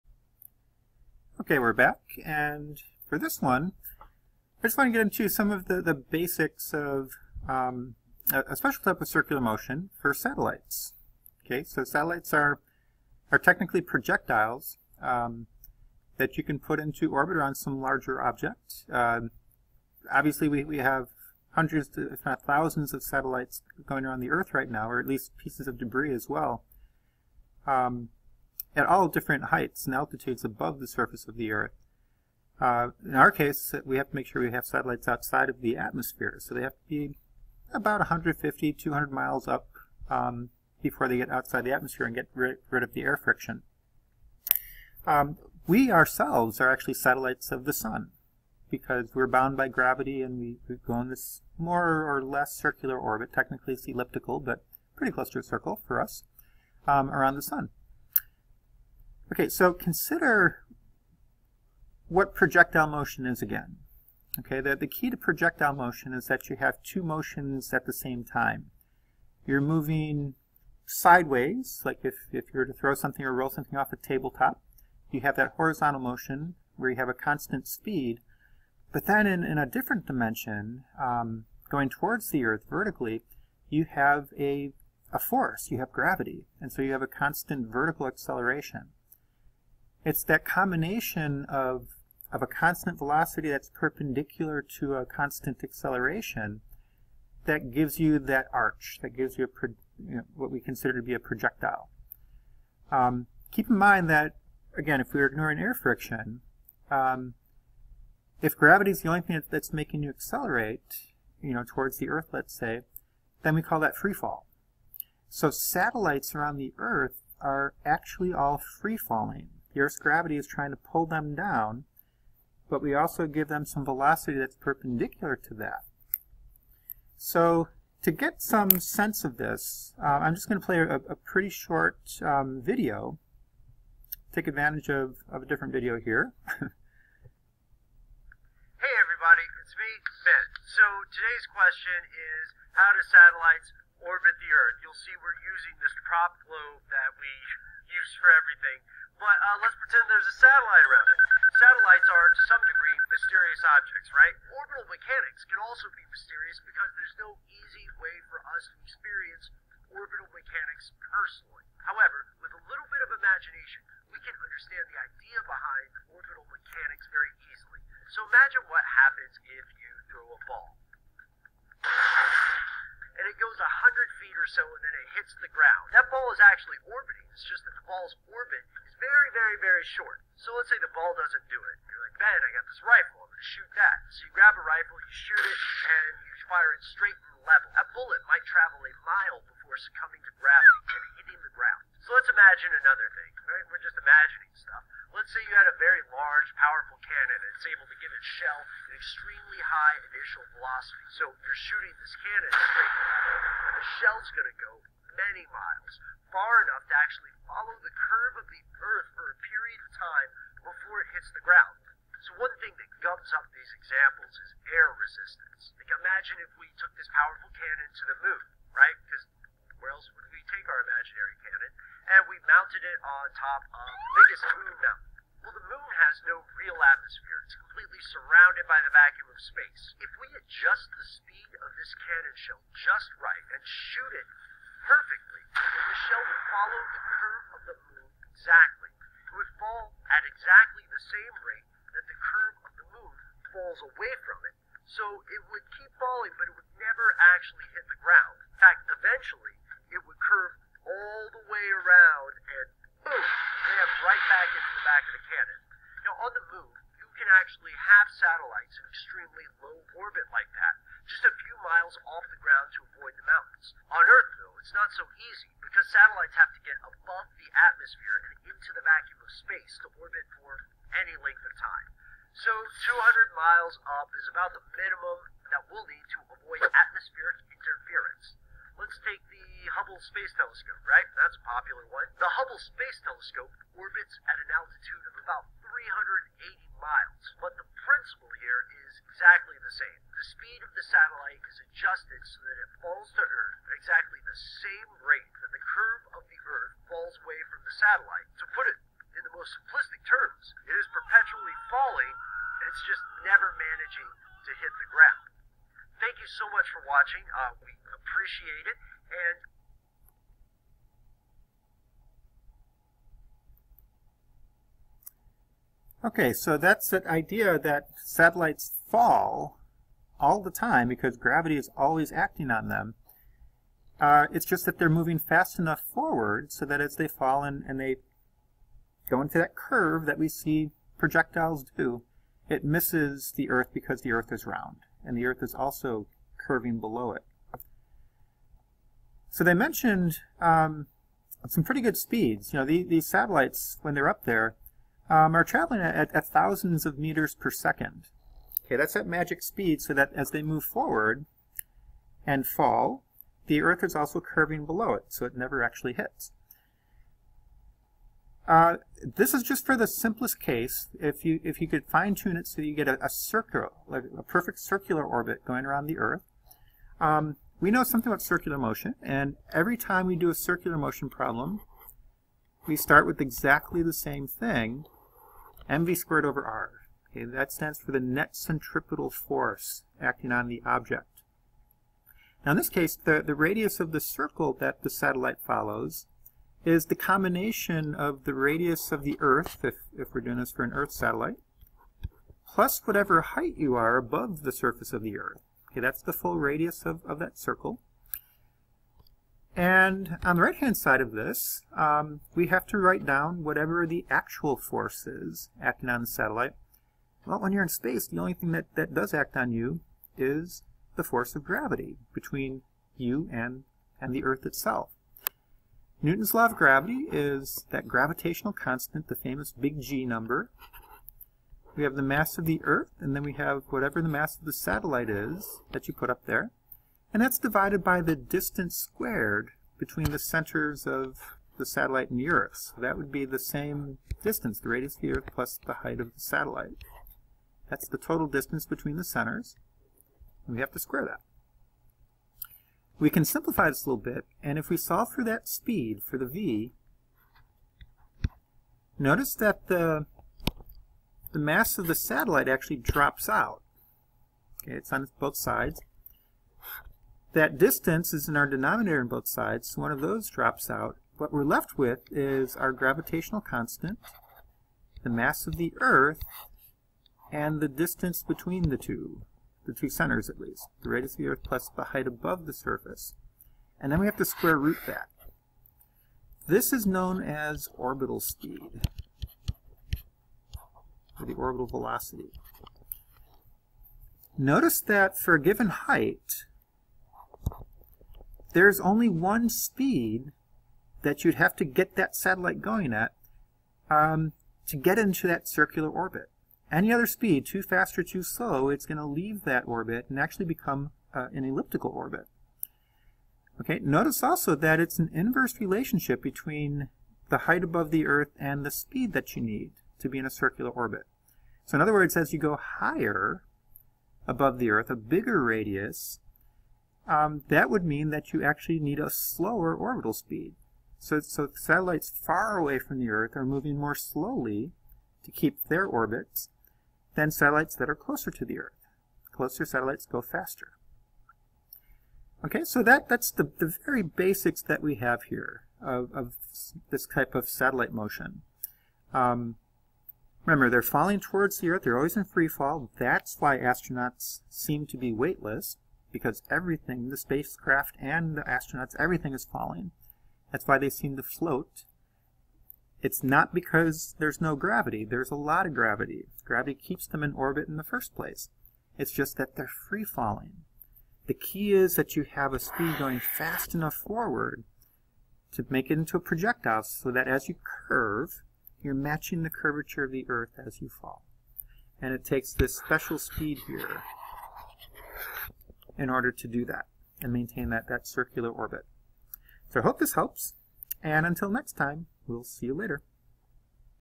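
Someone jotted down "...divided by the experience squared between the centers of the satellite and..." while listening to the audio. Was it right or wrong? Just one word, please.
wrong.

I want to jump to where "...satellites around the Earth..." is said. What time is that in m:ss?
1:55.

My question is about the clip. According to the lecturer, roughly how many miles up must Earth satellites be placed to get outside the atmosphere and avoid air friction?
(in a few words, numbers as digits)
150-200 miles.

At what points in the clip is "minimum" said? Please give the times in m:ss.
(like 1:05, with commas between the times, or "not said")
4:34.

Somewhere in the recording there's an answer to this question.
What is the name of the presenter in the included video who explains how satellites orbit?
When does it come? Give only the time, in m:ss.
2:20.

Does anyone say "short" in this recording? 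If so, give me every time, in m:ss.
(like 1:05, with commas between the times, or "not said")
2:11, 2:59.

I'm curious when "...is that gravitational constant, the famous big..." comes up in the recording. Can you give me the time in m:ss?
6:57.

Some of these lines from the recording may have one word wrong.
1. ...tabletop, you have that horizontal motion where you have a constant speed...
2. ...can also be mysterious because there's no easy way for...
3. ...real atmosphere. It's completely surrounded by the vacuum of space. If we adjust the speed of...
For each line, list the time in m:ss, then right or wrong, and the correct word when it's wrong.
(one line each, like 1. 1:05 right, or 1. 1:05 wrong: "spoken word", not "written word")
1. 1:13 right
2. 2:35 right
3. 3:46 right.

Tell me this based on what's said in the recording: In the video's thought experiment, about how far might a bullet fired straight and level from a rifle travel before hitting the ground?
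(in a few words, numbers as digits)
a mile.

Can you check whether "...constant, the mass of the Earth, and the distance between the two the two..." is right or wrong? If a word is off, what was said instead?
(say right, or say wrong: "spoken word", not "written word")
right.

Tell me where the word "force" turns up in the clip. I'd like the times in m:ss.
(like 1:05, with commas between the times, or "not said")
1:25, 6:19, 6:44, 6:51.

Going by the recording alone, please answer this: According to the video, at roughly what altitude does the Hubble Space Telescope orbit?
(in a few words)
380 miles.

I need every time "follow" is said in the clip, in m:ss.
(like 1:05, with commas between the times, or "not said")
3:27, 3:56, 6:25.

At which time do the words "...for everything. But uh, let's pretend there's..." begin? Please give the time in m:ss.
2:28.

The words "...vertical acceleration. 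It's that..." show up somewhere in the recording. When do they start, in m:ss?
1:27.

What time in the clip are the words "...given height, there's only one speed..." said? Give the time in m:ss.
8:05.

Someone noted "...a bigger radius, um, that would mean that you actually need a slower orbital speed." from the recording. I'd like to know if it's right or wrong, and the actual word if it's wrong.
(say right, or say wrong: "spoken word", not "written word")
right.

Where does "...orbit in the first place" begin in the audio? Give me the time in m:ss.
9:17.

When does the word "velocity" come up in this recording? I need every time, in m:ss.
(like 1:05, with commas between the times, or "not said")
1:32, 2:03, 3:20, 8:01.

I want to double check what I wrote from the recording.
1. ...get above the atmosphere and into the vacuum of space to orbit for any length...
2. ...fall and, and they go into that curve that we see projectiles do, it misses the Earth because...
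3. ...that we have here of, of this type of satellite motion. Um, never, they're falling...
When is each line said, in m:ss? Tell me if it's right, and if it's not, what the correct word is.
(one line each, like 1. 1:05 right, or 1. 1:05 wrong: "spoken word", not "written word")
1. 4:26 right
2. 5:27 right
3. 8:54 wrong: "remember", not "never".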